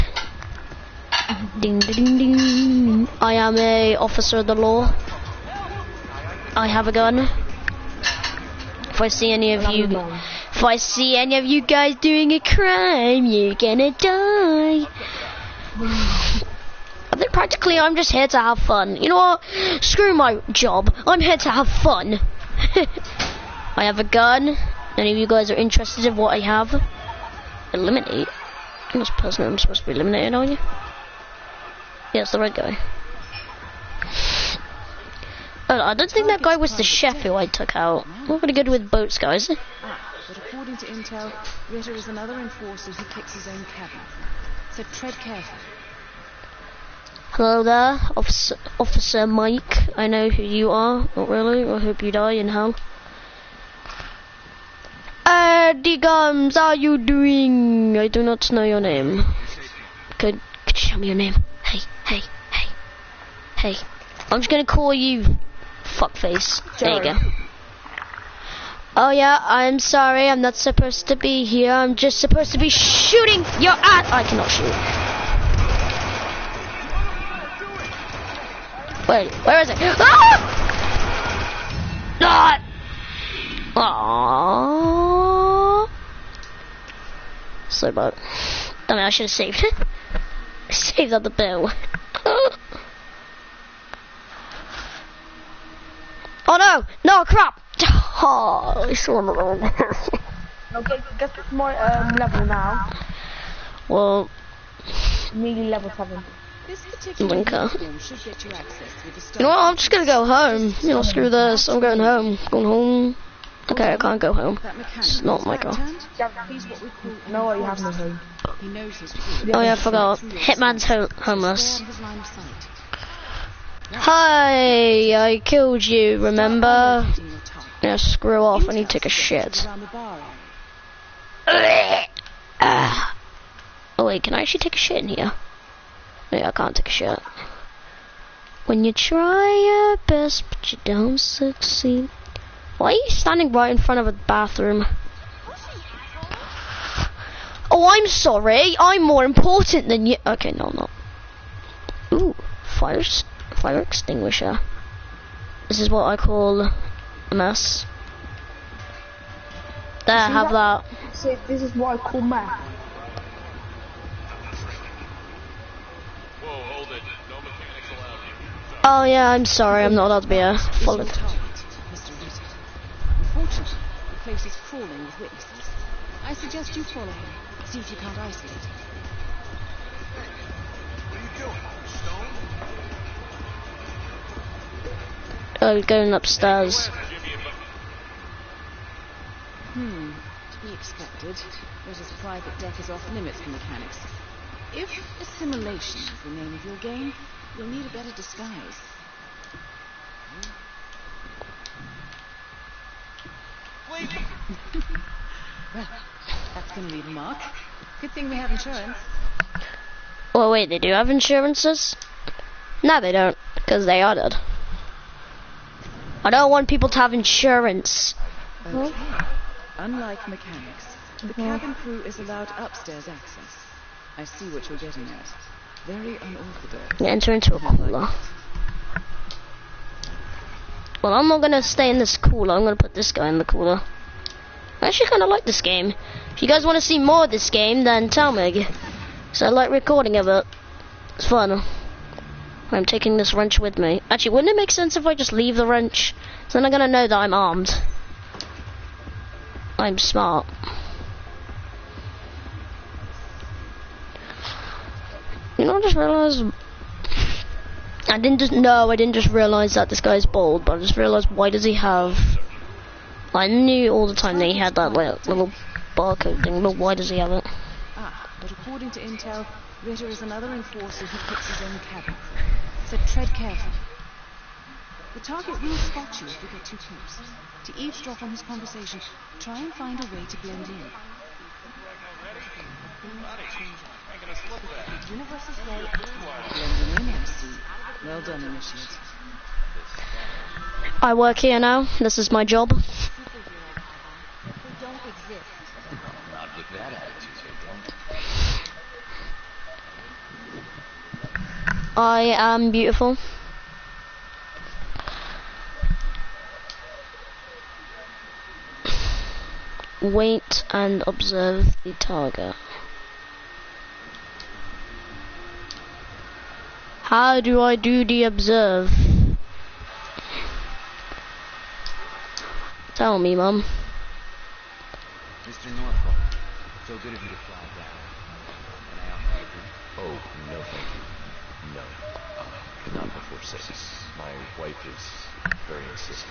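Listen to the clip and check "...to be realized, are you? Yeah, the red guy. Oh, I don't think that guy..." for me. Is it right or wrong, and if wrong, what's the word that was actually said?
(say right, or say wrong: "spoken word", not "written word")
wrong: "eliminated", not "realized".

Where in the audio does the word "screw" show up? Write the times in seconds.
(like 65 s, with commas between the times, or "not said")
19 s, 111 s, 127 s.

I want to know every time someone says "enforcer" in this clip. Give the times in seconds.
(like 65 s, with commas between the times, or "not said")
42 s, 270 s.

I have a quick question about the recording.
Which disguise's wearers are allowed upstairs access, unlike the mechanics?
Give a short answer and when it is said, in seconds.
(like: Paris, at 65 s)
cabin crew, at 221 s.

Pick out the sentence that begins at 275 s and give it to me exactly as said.
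The target will spot you if you get too close.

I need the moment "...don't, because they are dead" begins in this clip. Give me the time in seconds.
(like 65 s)
213 s.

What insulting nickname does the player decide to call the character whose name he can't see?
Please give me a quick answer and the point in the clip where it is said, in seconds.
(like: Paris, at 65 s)
fuckface, at 65 s.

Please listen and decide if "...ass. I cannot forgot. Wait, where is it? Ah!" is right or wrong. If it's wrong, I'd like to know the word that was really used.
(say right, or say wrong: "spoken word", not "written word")
wrong: "shoot", not "forgot".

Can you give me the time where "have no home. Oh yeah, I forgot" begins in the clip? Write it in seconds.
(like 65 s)
115 s.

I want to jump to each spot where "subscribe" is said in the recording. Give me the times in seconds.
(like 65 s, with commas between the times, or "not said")
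not said.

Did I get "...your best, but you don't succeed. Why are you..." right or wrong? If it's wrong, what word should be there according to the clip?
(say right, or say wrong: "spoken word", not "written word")
right.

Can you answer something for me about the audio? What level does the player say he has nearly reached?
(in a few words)
7.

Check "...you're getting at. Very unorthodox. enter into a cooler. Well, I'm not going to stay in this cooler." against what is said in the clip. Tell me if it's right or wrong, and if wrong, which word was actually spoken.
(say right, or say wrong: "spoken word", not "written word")
right.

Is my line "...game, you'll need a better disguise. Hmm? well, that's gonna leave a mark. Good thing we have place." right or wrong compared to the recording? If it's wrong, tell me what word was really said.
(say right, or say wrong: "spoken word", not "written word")
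wrong: "insurance", not "place".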